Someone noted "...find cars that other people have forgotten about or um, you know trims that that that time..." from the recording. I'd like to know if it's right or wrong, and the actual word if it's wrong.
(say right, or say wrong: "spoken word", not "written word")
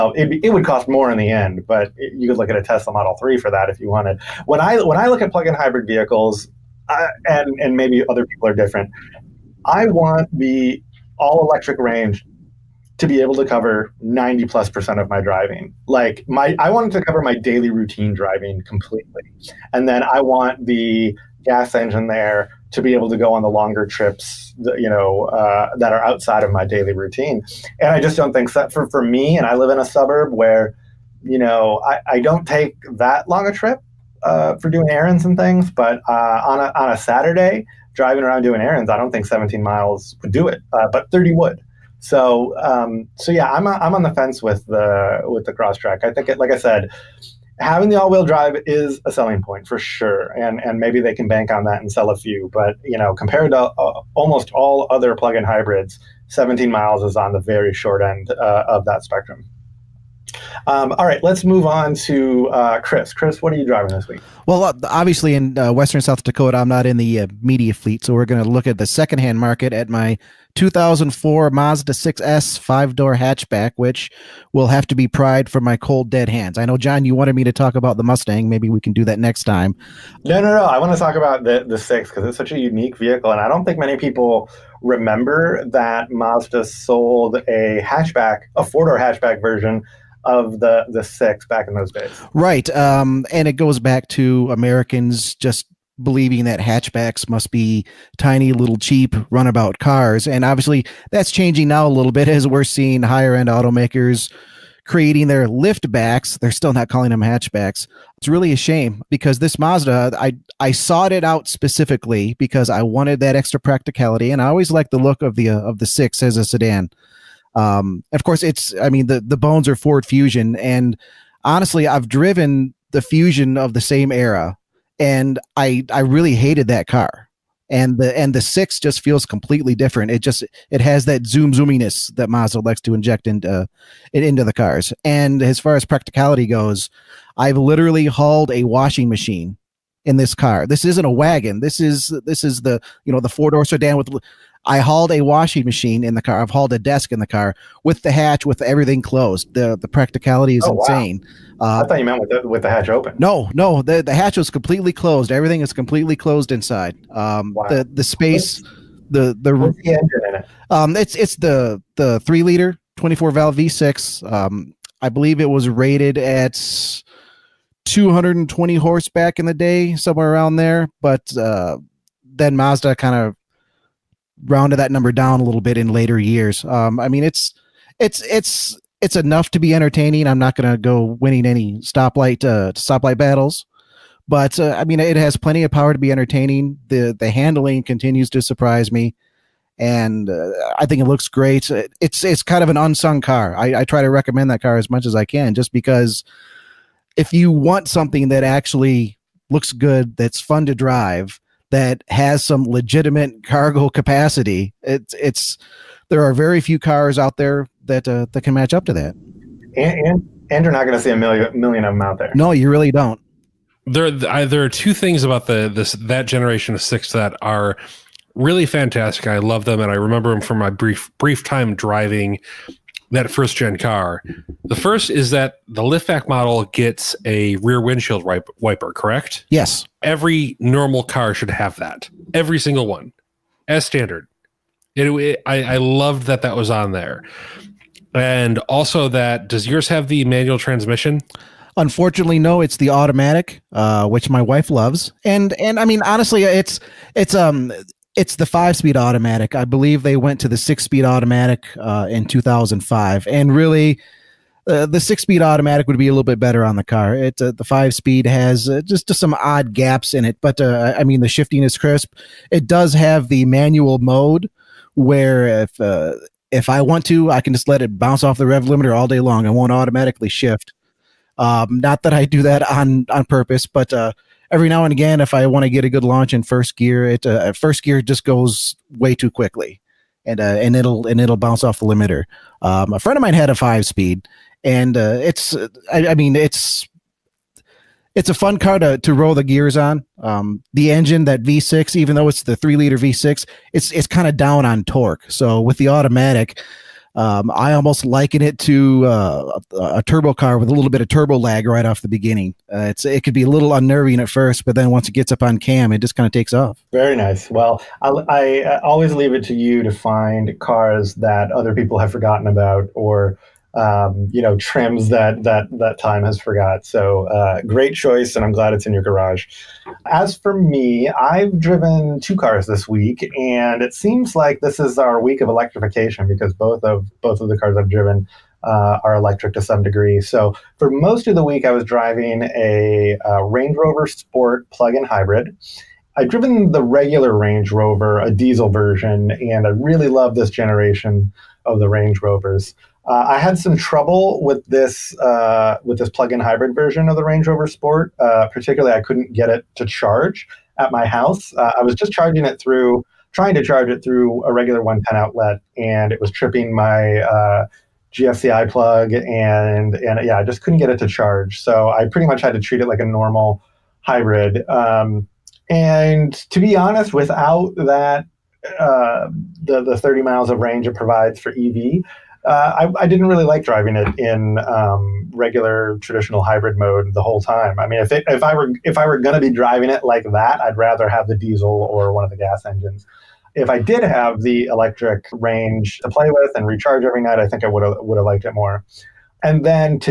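right.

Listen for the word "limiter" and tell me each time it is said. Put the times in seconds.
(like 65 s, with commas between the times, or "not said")
268 s, 281 s.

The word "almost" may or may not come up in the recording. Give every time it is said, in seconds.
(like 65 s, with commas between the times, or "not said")
54 s, 297 s.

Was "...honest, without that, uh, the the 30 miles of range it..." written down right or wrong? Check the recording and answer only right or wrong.
right.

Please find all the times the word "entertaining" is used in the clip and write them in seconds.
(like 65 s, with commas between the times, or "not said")
179 s, 186 s.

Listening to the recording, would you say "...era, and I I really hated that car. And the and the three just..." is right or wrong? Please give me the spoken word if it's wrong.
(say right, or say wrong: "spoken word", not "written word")
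wrong: "six", not "three".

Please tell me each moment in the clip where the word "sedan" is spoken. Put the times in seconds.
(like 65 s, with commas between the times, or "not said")
116 s, 143 s.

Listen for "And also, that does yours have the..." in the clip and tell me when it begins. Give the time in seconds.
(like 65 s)
238 s.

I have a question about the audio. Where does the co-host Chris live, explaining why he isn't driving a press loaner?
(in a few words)
Western South Dakota.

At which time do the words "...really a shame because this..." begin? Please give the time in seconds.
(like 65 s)
108 s.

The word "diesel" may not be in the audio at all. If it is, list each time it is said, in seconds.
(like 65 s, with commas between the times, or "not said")
338 s, 381 s.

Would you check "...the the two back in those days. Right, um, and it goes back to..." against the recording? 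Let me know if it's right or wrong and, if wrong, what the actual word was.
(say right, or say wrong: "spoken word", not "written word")
wrong: "six", not "two".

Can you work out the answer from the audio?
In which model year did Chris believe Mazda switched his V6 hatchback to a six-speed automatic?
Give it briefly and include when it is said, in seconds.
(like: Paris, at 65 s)
2005, at 252 s.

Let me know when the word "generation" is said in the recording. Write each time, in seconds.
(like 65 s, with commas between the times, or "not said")
216 s, 340 s.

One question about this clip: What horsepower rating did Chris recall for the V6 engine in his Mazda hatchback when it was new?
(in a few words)
220.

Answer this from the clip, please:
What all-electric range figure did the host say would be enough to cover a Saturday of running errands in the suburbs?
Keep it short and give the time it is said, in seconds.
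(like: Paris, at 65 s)
30 miles, at 41 s.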